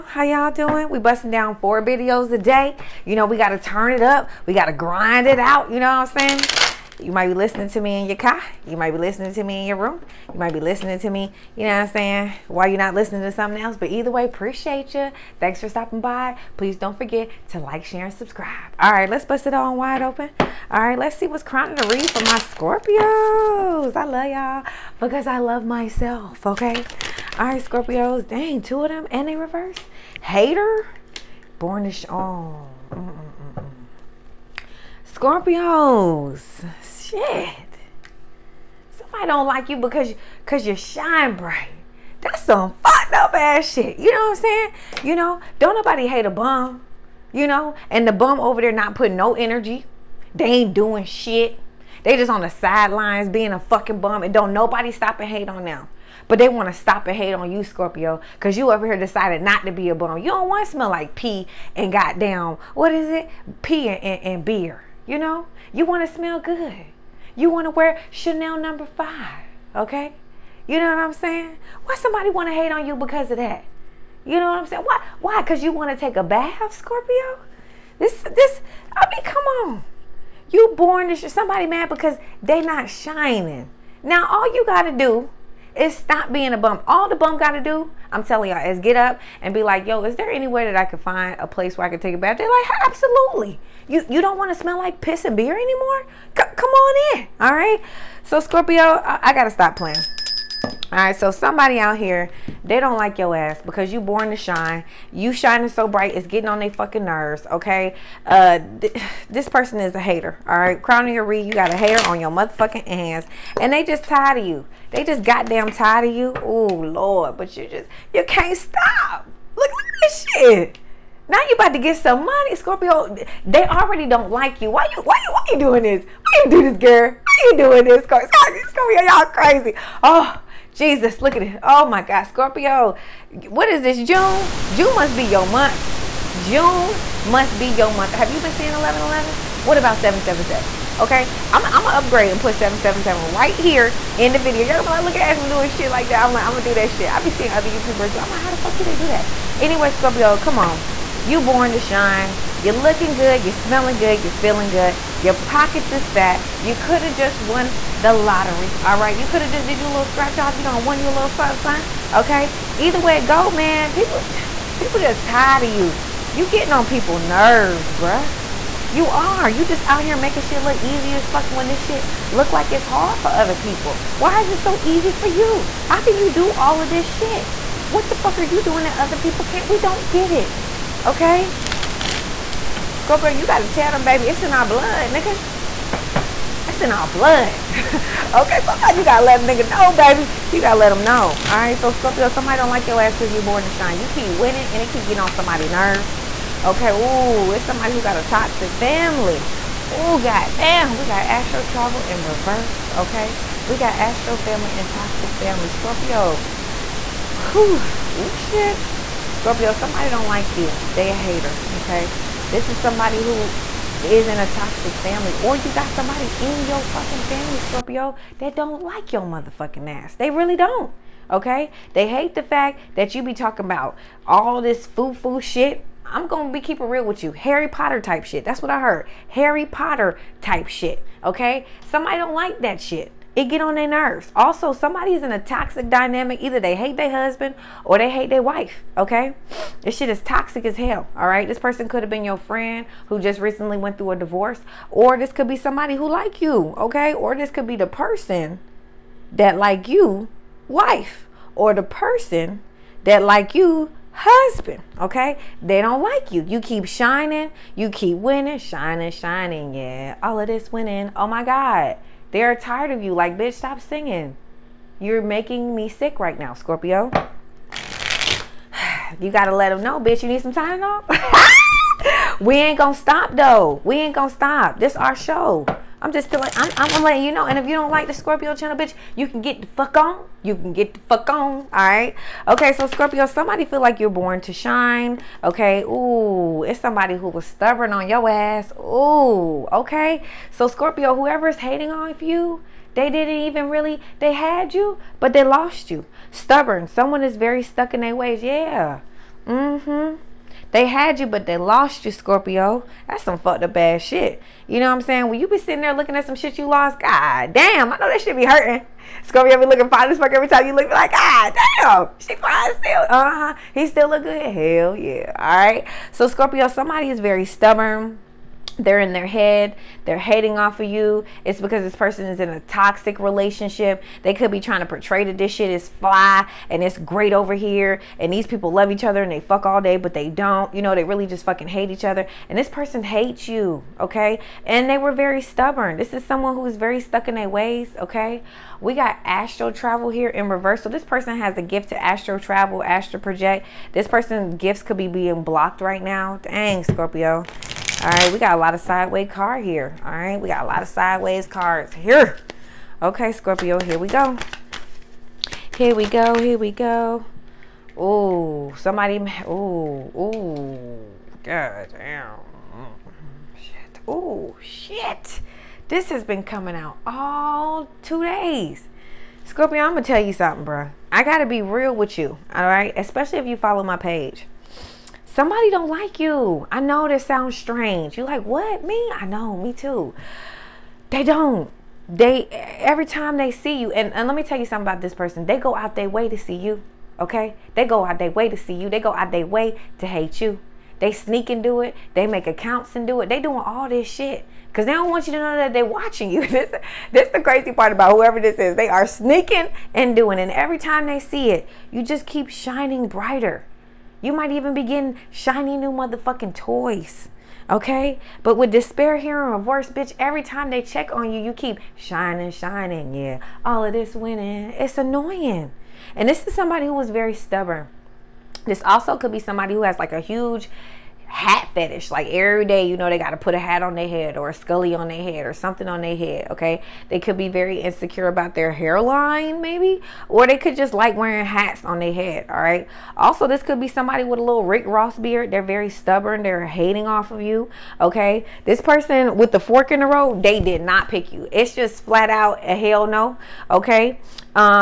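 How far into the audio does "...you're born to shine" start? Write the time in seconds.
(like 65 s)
283 s.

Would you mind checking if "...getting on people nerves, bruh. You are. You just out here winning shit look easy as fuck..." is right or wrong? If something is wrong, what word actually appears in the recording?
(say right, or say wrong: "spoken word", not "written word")
wrong: "making", not "winning".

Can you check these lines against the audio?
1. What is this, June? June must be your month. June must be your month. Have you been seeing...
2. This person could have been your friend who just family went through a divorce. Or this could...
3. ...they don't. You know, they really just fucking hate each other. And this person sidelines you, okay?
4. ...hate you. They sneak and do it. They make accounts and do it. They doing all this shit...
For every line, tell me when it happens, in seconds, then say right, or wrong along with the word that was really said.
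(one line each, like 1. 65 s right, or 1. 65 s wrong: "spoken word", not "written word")
1. 133 s right
2. 241 s wrong: "recently", not "family"
3. 330 s wrong: "hates", not "sidelines"
4. 390 s right.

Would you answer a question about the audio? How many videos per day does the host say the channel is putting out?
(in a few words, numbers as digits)
4.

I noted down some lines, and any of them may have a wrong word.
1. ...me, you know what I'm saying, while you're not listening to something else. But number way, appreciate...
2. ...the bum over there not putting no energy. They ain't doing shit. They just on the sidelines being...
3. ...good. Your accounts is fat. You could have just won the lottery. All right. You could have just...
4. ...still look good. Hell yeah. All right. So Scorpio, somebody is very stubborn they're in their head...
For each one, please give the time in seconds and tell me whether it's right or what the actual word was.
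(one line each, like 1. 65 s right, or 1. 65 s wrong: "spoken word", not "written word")
1. 11 s wrong: "either", not "number"
2. 48 s right
3. 154 s wrong: "pockets", not "accounts"
4. 313 s right.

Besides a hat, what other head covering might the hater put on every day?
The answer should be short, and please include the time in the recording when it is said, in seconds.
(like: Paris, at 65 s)
scully, at 424 s.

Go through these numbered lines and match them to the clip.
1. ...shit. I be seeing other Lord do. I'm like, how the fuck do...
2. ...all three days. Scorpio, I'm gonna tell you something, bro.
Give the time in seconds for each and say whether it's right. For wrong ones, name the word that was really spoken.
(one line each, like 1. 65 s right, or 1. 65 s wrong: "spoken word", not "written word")
1. 146 s wrong: "YouTubers", not "Lord"
2. 367 s wrong: "two", not "three".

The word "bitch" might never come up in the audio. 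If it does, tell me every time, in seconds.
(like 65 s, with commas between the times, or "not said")
263 s, 269 s, 278 s, 409 s.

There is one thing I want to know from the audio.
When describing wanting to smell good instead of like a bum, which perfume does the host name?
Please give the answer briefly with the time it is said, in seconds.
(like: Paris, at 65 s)
Chanel number five, at 68 s.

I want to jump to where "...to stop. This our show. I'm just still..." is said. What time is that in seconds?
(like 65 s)
274 s.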